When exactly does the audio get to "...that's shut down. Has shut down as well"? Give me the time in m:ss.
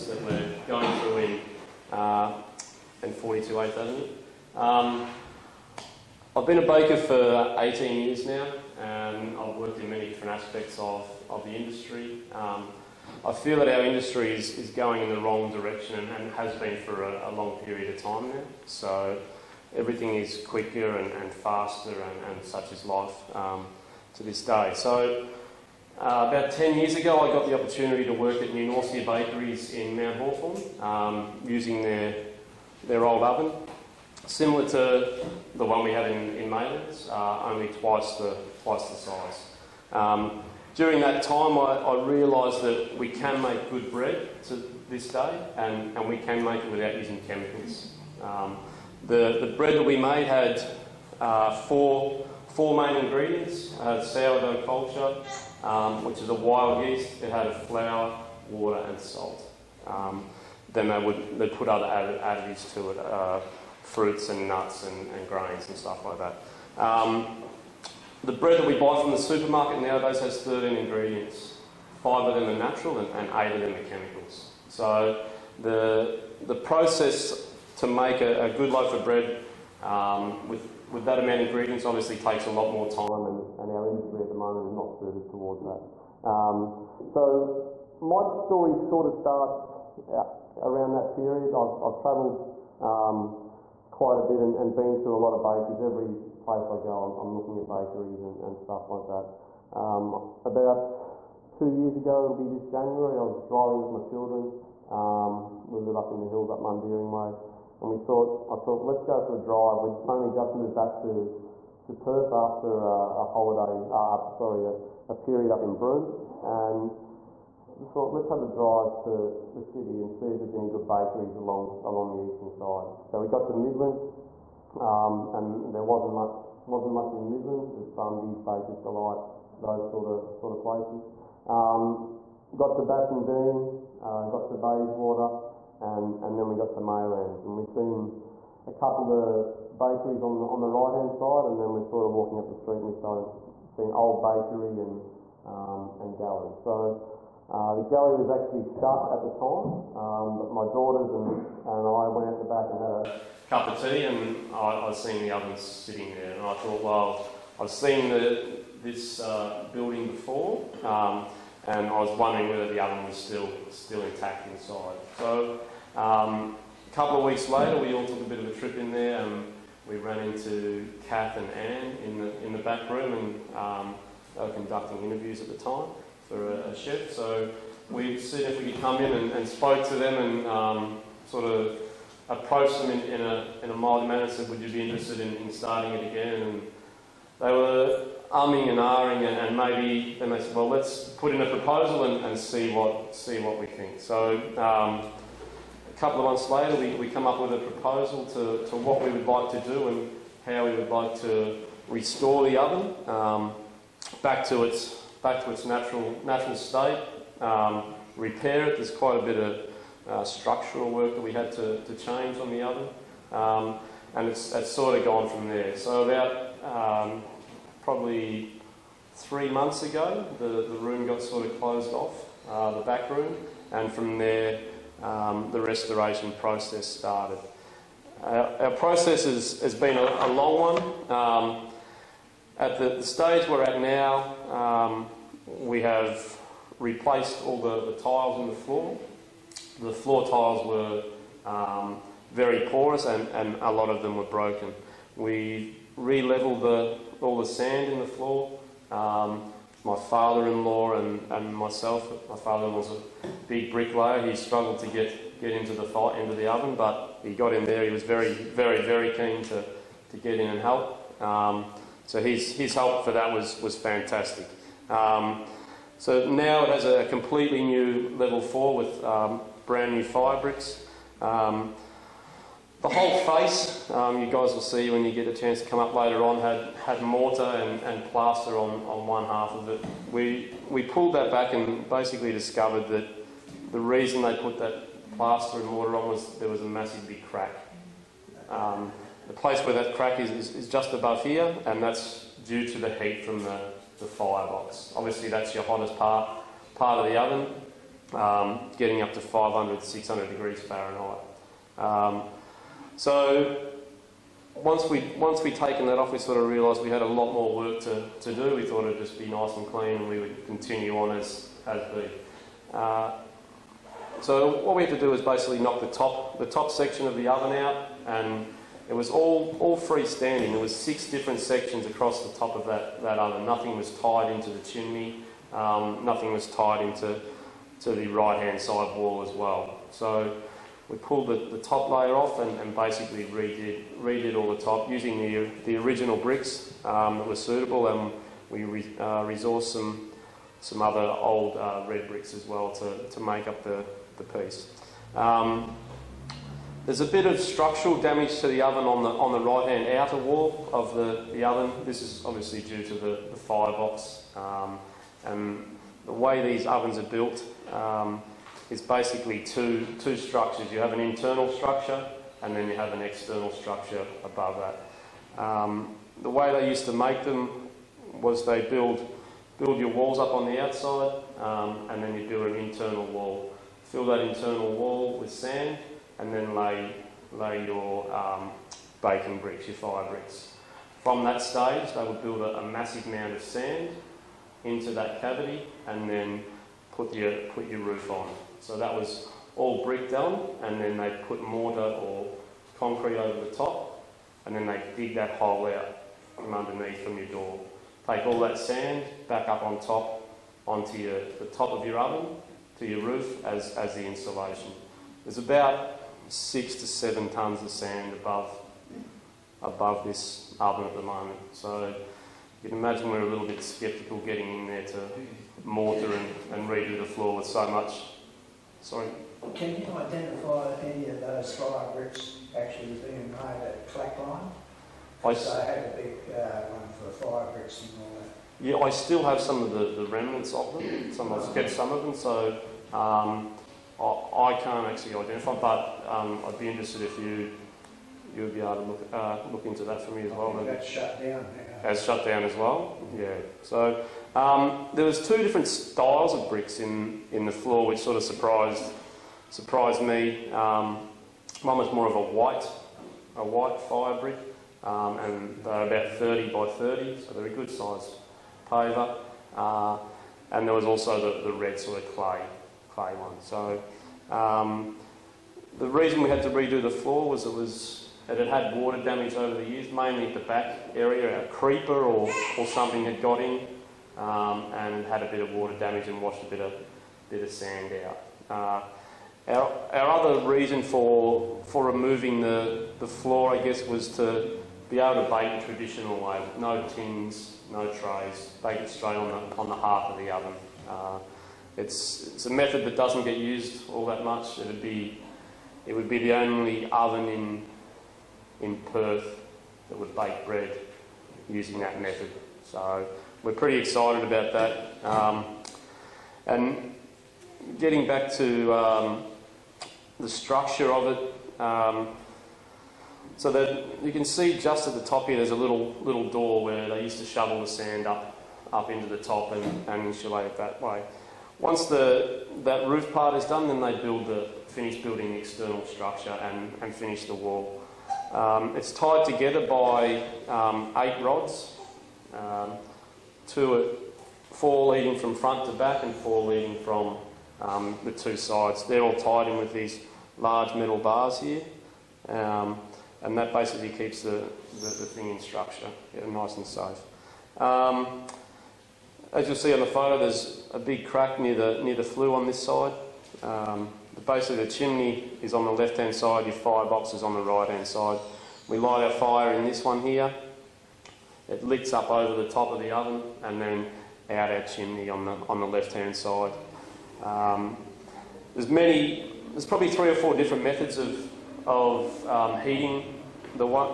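7:20.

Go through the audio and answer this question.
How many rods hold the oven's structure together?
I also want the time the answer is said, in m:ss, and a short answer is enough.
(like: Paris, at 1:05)
8, at 8:50.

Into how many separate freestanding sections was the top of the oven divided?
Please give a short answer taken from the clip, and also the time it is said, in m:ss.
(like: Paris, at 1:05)
6, at 5:20.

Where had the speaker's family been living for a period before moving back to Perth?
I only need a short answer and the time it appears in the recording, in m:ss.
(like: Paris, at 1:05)
Broome, at 1:55.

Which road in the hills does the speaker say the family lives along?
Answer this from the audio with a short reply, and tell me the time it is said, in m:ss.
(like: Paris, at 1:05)
Mundaring Way, at 1:46.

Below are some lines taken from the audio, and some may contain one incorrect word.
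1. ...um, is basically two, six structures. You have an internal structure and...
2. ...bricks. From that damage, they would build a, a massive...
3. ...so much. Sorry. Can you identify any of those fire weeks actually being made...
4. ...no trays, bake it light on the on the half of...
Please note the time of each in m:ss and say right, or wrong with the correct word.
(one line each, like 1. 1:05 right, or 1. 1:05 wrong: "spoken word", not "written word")
1. 5:57 wrong: "two", not "six"
2. 6:20 wrong: "stage", not "damage"
3. 6:57 wrong: "bricks", not "weeks"
4. 8:07 wrong: "straight", not "light".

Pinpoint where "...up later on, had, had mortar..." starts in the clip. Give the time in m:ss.
4:35.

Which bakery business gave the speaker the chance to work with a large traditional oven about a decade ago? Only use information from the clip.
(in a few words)
New Norcia Bakeries.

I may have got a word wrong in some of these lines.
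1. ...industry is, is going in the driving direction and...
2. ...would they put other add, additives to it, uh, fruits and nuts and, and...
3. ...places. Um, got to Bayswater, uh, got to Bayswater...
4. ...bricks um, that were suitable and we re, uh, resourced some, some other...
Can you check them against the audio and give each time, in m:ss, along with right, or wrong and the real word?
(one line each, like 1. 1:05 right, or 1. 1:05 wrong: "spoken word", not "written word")
1. 0:13 wrong: "wrong", not "driving"
2. 1:00 right
3. 2:10 wrong: "Bassendean", not "Bayswater"
4. 5:36 right.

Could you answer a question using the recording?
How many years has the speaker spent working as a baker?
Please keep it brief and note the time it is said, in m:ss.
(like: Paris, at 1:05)
18, at 0:07.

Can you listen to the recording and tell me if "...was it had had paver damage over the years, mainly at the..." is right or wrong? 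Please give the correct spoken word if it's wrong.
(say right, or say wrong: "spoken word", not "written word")
wrong: "water", not "paver".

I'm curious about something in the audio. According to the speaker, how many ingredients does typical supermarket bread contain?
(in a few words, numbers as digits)
13.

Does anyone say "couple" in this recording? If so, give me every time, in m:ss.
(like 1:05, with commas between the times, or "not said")
2:18, 2:46, 3:15.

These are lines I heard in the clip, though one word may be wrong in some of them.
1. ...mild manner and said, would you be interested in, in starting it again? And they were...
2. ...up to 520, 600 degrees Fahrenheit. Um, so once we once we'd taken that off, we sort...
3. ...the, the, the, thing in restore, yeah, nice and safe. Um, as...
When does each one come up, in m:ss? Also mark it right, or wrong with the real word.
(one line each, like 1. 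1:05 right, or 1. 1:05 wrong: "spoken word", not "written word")
1. 3:03 right
2. 4:59 wrong: "500", not "520"
3. 9:04 wrong: "structure", not "restore".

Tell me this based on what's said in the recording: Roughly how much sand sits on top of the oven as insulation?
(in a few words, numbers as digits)
6 to 7 tons.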